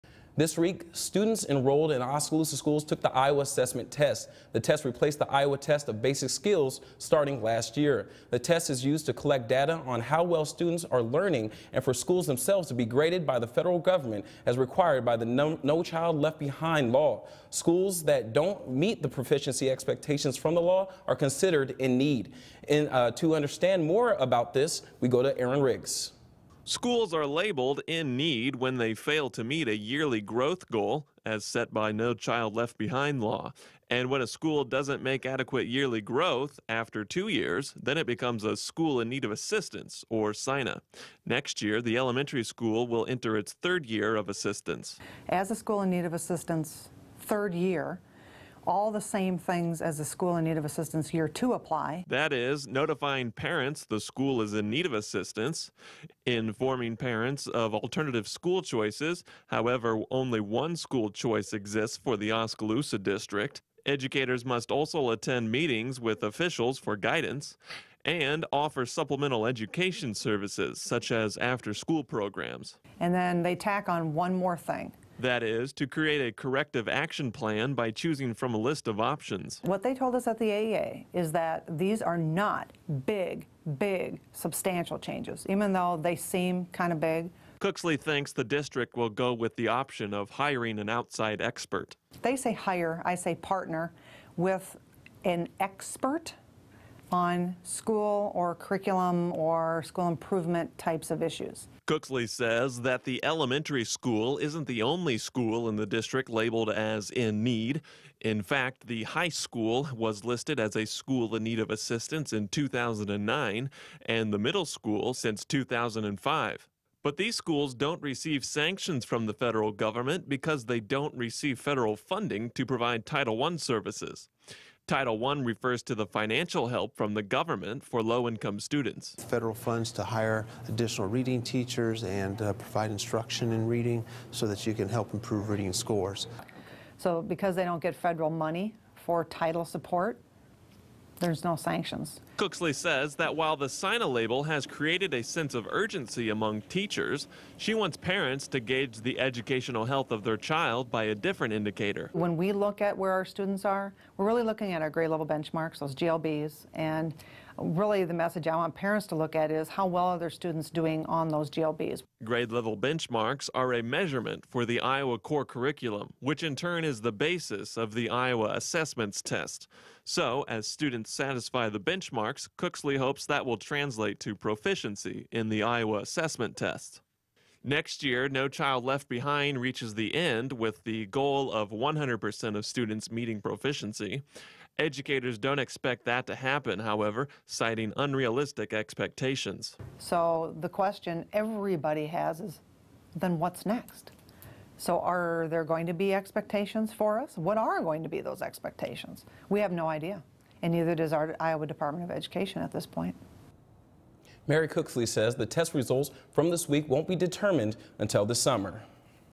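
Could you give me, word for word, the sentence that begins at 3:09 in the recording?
So the question everybody has is then what's next?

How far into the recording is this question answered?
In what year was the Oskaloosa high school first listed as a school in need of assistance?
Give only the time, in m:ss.
1:52.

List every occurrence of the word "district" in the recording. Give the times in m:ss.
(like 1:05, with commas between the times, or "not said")
1:02, 1:28, 1:45.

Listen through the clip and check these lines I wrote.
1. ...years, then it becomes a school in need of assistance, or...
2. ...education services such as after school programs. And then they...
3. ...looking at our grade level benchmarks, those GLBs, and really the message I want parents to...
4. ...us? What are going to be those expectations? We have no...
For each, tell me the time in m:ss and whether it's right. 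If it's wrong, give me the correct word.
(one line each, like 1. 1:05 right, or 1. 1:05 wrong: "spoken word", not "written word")
1. 0:37 right
2. 1:09 right
3. 2:34 right
4. 3:17 right.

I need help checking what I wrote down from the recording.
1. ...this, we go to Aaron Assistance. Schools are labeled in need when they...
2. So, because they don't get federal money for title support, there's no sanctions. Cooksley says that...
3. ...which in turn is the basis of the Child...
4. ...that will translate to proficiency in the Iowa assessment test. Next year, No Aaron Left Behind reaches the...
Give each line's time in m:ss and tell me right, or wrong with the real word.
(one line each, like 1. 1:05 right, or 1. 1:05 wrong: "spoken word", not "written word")
1. 0:24 wrong: "Riggs", not "Assistance"
2. 2:16 right
3. 2:46 wrong: "Iowa", not "Child"
4. 2:53 wrong: "Child", not "Aaron".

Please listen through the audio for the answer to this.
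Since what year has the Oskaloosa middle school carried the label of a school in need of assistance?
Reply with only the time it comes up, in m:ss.
1:55.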